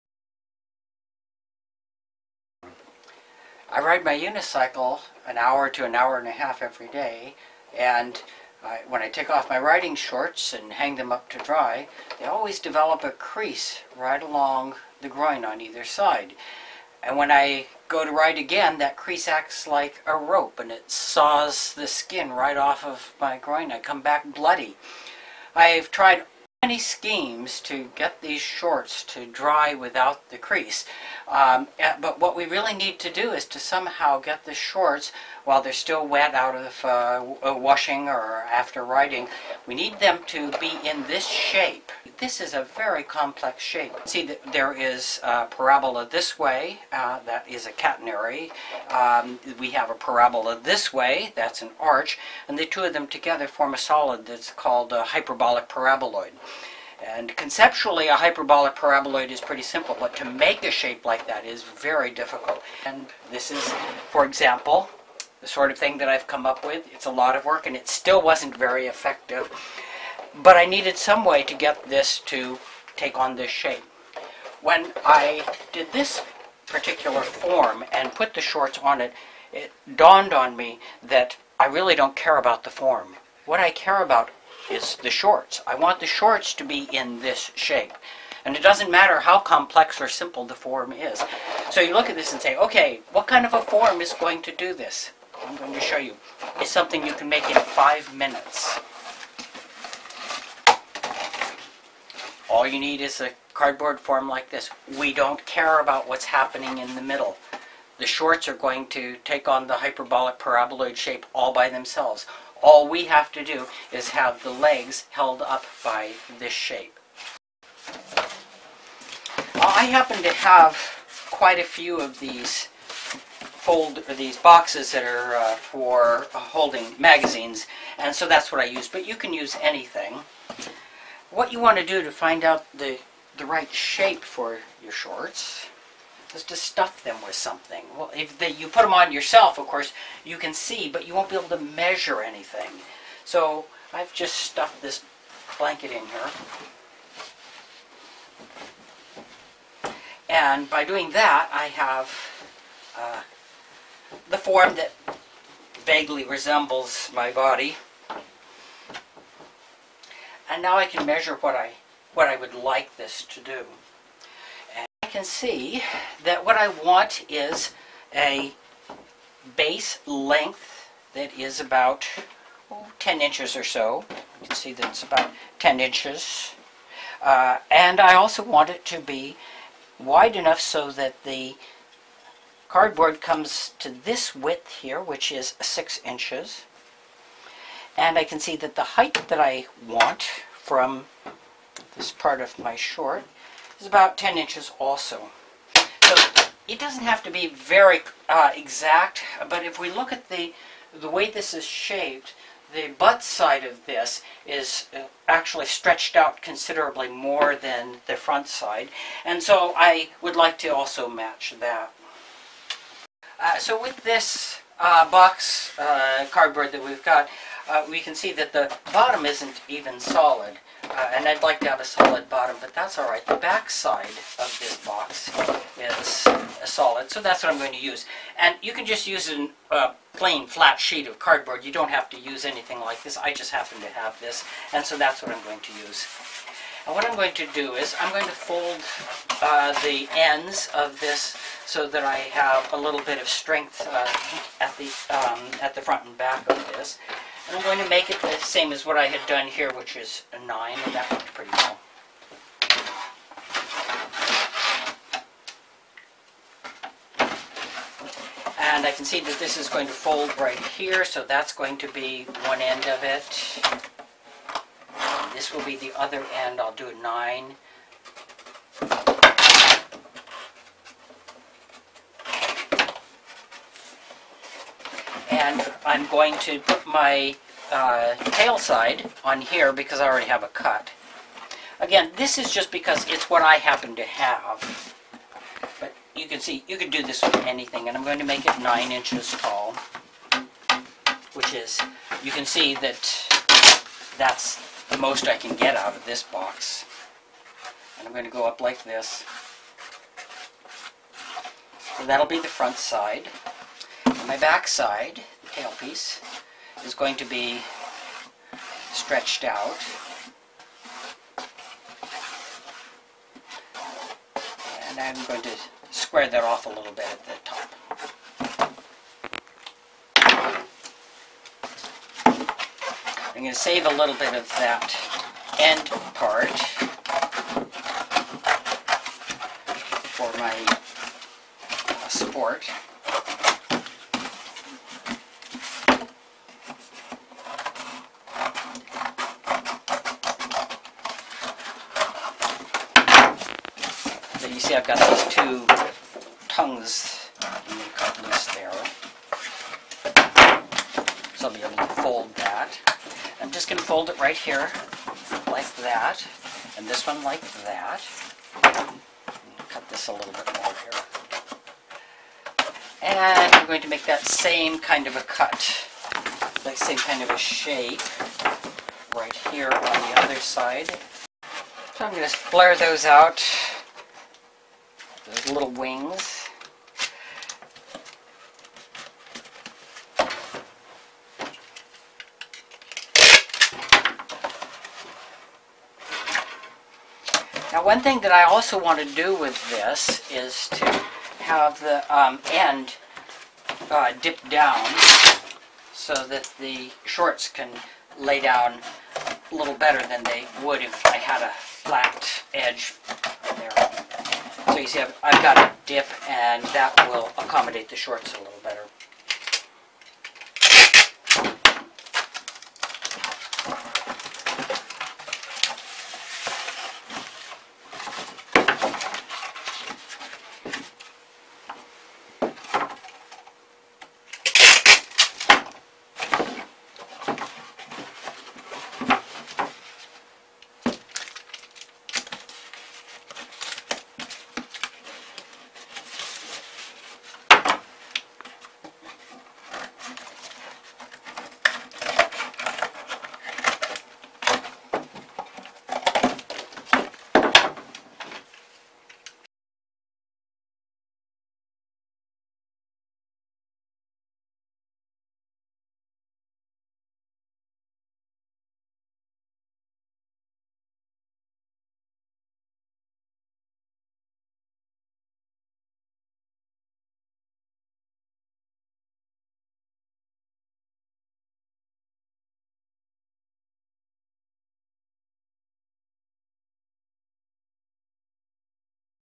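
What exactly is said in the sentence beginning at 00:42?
This is a very complex shape.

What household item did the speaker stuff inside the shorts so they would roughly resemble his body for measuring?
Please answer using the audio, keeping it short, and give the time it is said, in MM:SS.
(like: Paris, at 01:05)
blanket, at 02:25.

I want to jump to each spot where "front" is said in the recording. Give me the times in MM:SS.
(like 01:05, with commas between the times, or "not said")
03:28, 04:05, 05:02.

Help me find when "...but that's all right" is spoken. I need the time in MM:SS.
03:42.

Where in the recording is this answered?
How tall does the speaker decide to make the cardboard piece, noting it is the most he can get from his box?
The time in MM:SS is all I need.
04:48.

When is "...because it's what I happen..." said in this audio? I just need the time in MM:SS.
04:42.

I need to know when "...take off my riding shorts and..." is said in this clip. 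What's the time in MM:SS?
00:09.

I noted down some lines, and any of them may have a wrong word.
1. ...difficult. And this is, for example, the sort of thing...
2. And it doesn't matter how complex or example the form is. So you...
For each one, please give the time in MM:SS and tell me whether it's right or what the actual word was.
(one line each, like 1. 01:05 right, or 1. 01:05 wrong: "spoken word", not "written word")
1. 01:02 right
2. 01:28 wrong: "simple", not "example".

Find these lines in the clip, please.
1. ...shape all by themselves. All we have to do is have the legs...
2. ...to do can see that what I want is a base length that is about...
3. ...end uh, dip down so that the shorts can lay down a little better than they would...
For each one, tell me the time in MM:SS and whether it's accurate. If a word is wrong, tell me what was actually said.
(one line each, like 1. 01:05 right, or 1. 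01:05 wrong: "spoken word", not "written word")
1. 01:50 right
2. 02:43 right
3. 06:32 right.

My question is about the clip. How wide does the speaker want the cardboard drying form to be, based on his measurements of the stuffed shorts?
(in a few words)
6 inches.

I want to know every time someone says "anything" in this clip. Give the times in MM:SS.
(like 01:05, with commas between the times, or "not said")
02:09, 02:22, 03:52, 04:47.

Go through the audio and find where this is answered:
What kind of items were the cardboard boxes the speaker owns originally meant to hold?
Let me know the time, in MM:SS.
02:06.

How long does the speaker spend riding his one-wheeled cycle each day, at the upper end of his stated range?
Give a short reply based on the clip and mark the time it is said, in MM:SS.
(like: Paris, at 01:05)
an hour and a half, at 00:05.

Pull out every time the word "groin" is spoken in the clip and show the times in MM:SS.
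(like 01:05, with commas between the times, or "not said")
00:15, 00:23.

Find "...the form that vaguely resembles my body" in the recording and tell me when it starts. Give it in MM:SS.
02:34.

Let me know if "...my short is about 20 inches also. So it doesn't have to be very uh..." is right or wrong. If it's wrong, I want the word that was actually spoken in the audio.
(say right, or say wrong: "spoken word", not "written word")
wrong: "10", not "20".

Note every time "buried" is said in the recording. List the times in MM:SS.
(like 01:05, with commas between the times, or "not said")
not said.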